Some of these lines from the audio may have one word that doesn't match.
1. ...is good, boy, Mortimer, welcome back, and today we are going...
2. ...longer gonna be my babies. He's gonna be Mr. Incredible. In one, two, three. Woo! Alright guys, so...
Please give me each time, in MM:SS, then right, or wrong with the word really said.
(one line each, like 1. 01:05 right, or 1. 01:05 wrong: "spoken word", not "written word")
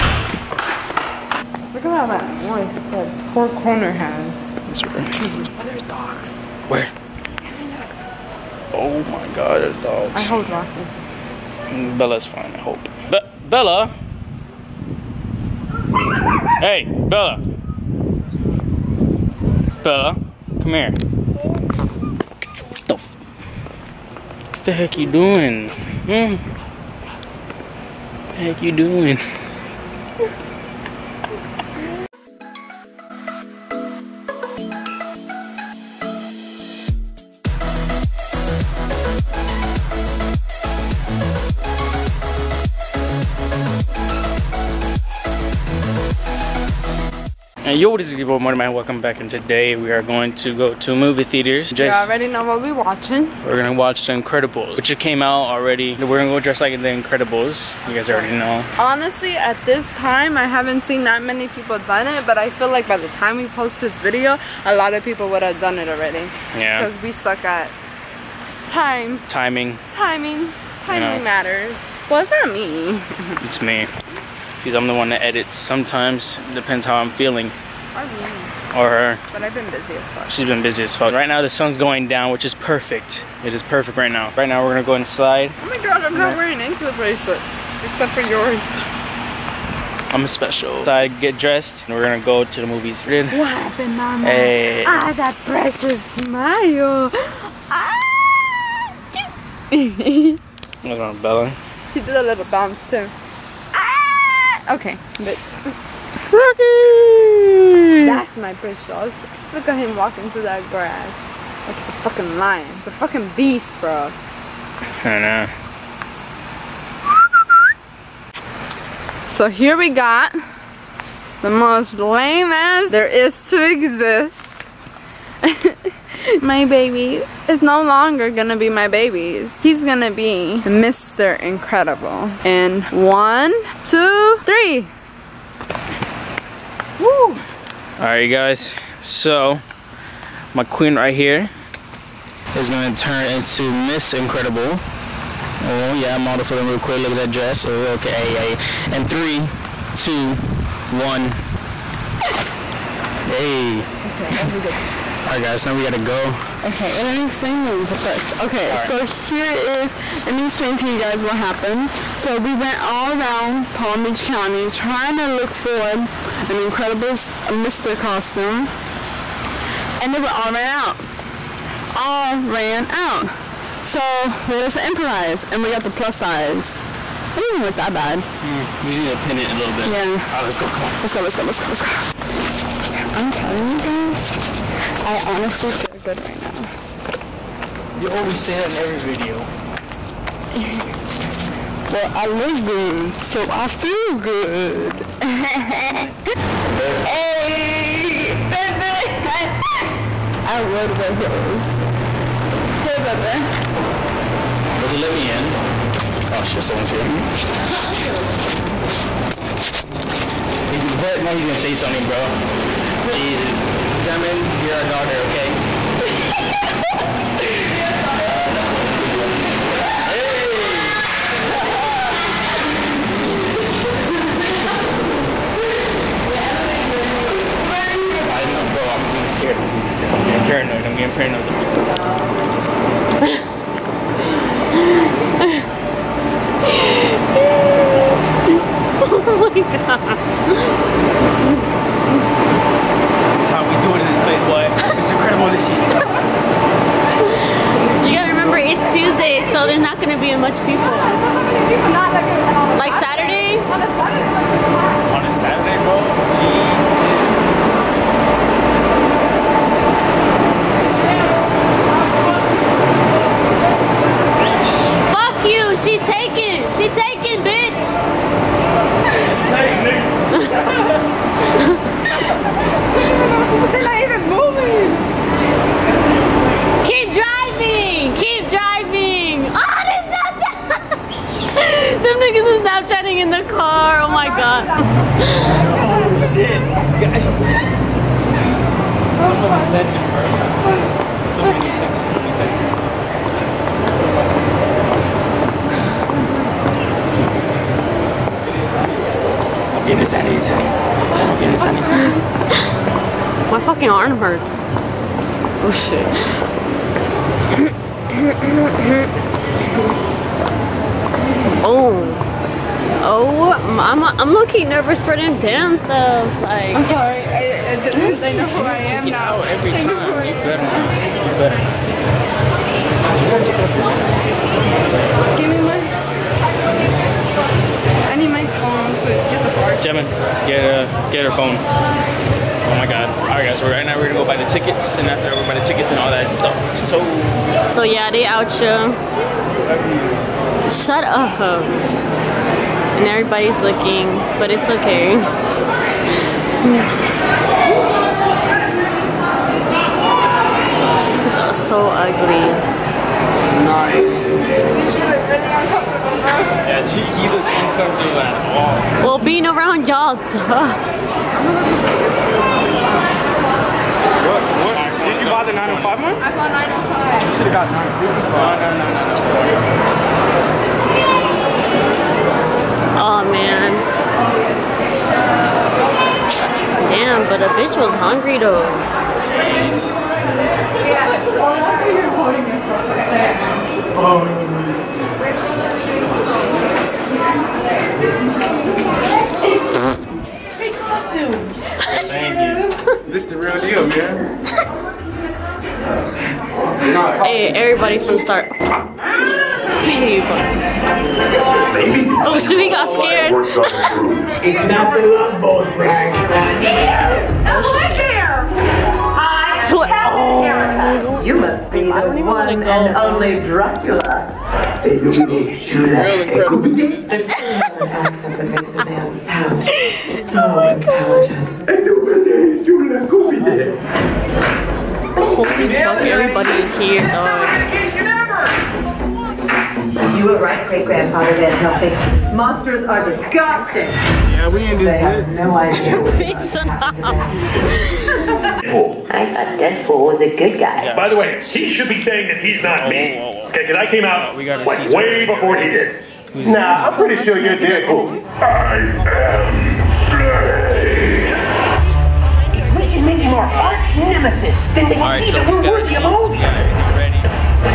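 1. 00:47 right
2. 02:07 right.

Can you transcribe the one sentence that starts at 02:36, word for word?
Okay, well, let me explain this first.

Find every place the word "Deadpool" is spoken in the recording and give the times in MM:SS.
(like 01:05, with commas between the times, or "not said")
07:19, 07:27.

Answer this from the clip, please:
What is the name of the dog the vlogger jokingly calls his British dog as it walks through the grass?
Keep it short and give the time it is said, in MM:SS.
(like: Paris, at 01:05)
Rocky, at 01:46.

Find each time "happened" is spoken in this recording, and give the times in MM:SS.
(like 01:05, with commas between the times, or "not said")
01:33, 02:41.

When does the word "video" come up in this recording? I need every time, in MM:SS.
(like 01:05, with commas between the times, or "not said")
01:03, 03:09.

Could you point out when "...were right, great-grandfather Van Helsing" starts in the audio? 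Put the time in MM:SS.
07:10.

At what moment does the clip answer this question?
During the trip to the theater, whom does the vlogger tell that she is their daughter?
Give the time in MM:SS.
03:34.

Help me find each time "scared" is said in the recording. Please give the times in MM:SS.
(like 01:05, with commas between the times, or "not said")
03:49, 06:42.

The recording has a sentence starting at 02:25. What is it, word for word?
Oh yeah, model for them real quick.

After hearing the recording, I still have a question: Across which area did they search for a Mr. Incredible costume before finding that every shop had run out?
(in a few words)
Palm Beach County.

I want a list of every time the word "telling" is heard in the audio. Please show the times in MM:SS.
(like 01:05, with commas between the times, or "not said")
03:03.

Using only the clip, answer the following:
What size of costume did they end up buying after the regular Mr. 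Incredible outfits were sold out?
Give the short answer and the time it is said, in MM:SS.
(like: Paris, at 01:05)
plus size, at 02:55.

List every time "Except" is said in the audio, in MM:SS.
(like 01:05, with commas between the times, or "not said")
01:27.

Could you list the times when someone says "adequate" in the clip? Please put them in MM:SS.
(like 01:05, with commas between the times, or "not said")
not said.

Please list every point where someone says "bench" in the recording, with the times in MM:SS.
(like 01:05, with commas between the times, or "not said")
not said.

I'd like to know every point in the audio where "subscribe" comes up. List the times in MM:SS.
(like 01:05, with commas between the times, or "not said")
not said.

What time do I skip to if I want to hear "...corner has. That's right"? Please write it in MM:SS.
00:03.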